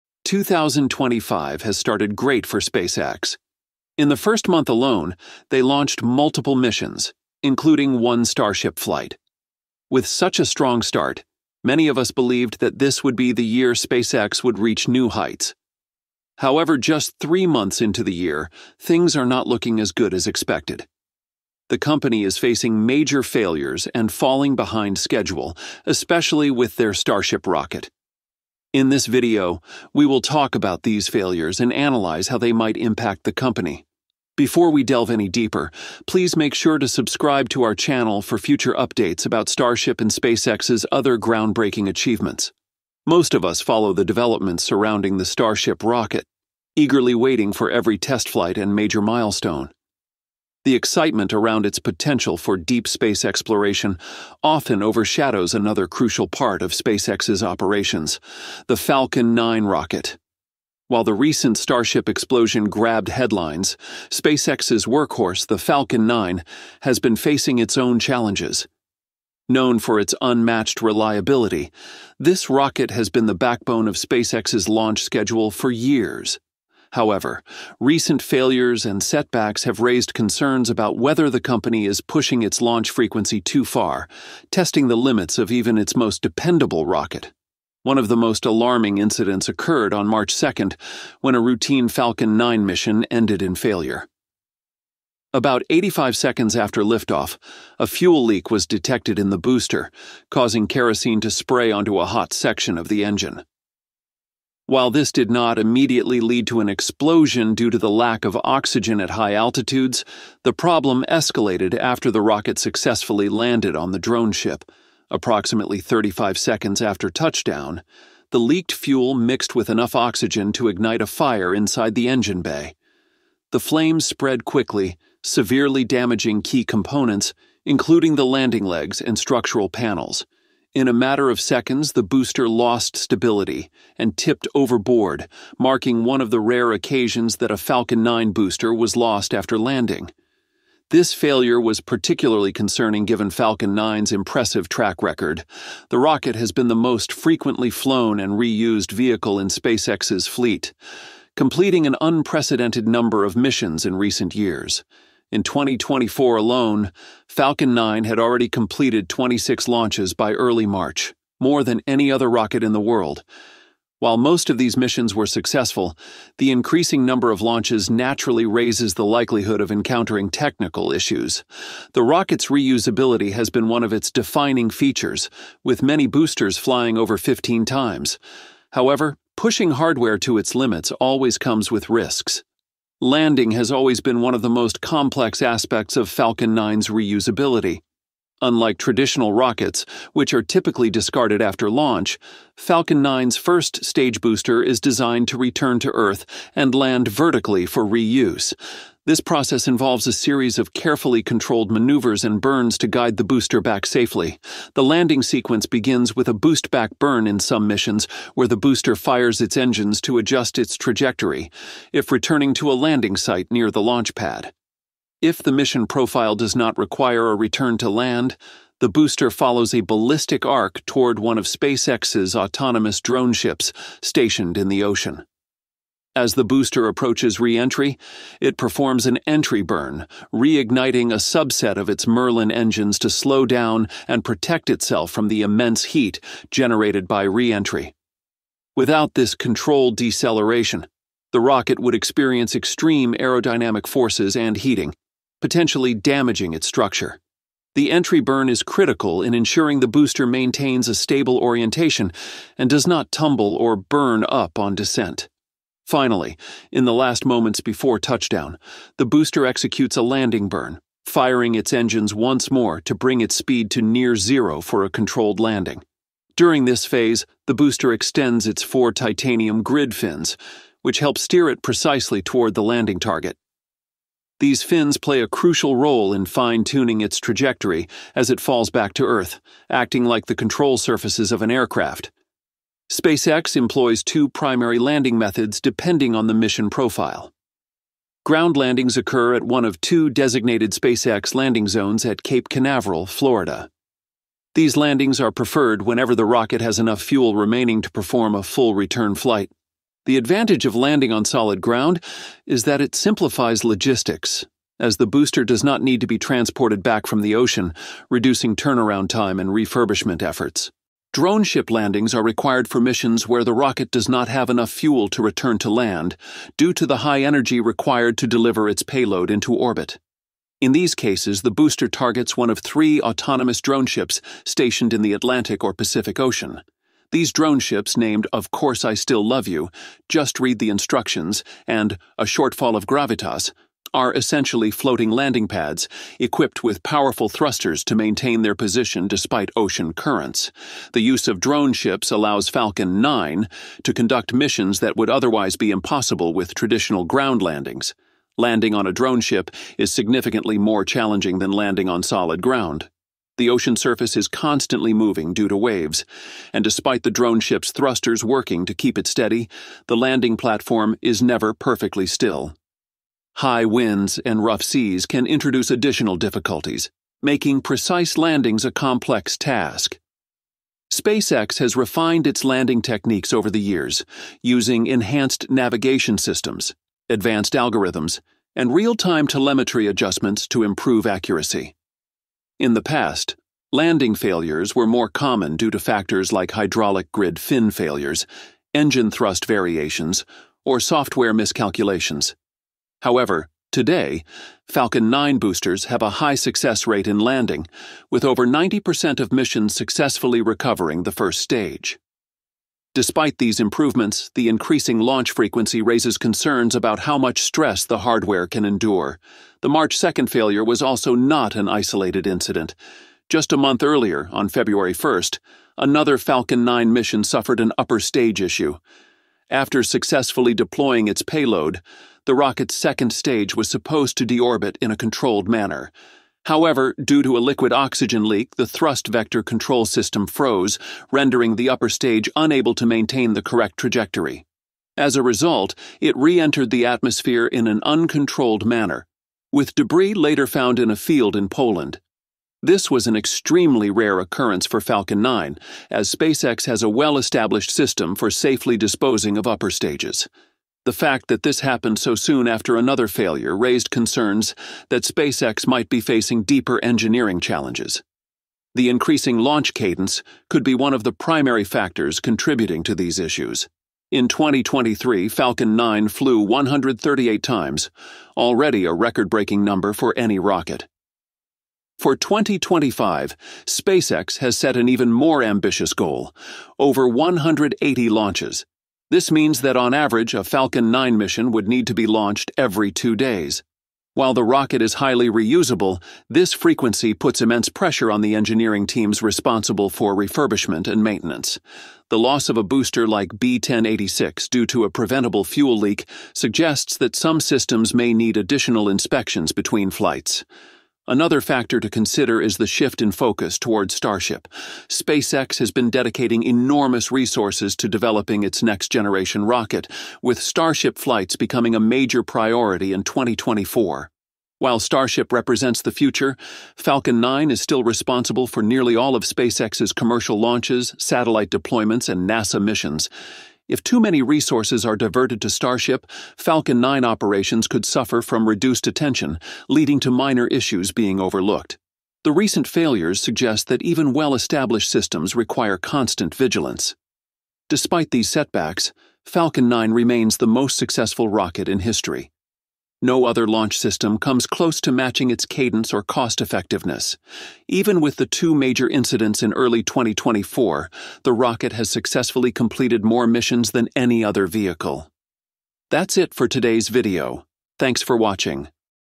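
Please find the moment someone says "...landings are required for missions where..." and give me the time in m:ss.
5:11.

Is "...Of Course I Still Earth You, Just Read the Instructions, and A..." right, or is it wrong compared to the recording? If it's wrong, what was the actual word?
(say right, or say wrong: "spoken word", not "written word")
wrong: "Love", not "Earth".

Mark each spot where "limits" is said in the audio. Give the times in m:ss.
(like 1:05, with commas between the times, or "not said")
1:24, 3:00.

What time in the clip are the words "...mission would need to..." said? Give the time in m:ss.
8:01.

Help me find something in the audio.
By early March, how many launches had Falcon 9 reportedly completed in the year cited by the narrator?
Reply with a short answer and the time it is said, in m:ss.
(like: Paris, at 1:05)
26, at 2:39.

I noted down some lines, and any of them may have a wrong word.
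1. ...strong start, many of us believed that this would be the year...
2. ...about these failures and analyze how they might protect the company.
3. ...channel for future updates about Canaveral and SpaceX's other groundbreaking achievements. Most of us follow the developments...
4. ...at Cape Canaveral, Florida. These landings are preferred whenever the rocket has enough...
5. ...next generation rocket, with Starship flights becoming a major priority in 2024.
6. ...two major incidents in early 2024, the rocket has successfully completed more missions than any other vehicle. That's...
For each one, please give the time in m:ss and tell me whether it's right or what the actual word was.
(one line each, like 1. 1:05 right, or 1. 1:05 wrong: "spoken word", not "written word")
1. 0:10 right
2. 0:30 wrong: "impact", not "protect"
3. 0:37 wrong: "Starship", not "Canaveral"
4. 4:52 right
5. 8:28 right
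6. 9:08 right.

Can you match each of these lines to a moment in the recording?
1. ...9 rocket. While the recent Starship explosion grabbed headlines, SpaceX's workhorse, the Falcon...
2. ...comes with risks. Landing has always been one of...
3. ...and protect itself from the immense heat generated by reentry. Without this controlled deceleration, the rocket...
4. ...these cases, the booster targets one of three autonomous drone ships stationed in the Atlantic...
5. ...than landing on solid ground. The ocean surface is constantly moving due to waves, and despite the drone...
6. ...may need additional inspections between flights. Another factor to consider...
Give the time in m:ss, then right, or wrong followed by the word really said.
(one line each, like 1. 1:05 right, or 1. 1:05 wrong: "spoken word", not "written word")
1. 0:59 right
2. 3:01 right
3. 3:54 right
4. 5:20 right
5. 5:51 right
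6. 8:17 right.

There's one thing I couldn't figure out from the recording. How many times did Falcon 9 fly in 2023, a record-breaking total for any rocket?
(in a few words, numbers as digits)
138.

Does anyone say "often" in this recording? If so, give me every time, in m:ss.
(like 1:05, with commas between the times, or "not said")
0:54.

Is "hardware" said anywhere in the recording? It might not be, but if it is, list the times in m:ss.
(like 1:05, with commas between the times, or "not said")
2:59, 6:47.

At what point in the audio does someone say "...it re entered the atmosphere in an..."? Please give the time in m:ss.
7:15.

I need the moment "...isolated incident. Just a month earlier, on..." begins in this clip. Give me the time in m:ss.
6:51.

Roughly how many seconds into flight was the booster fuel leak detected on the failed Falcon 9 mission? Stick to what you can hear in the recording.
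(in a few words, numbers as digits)
85 seconds.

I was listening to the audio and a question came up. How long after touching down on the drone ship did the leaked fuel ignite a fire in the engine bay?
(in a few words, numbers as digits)
35 seconds.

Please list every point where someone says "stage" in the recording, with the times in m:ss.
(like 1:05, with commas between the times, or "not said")
3:13, 6:41, 6:58, 7:03, 7:11, 7:29.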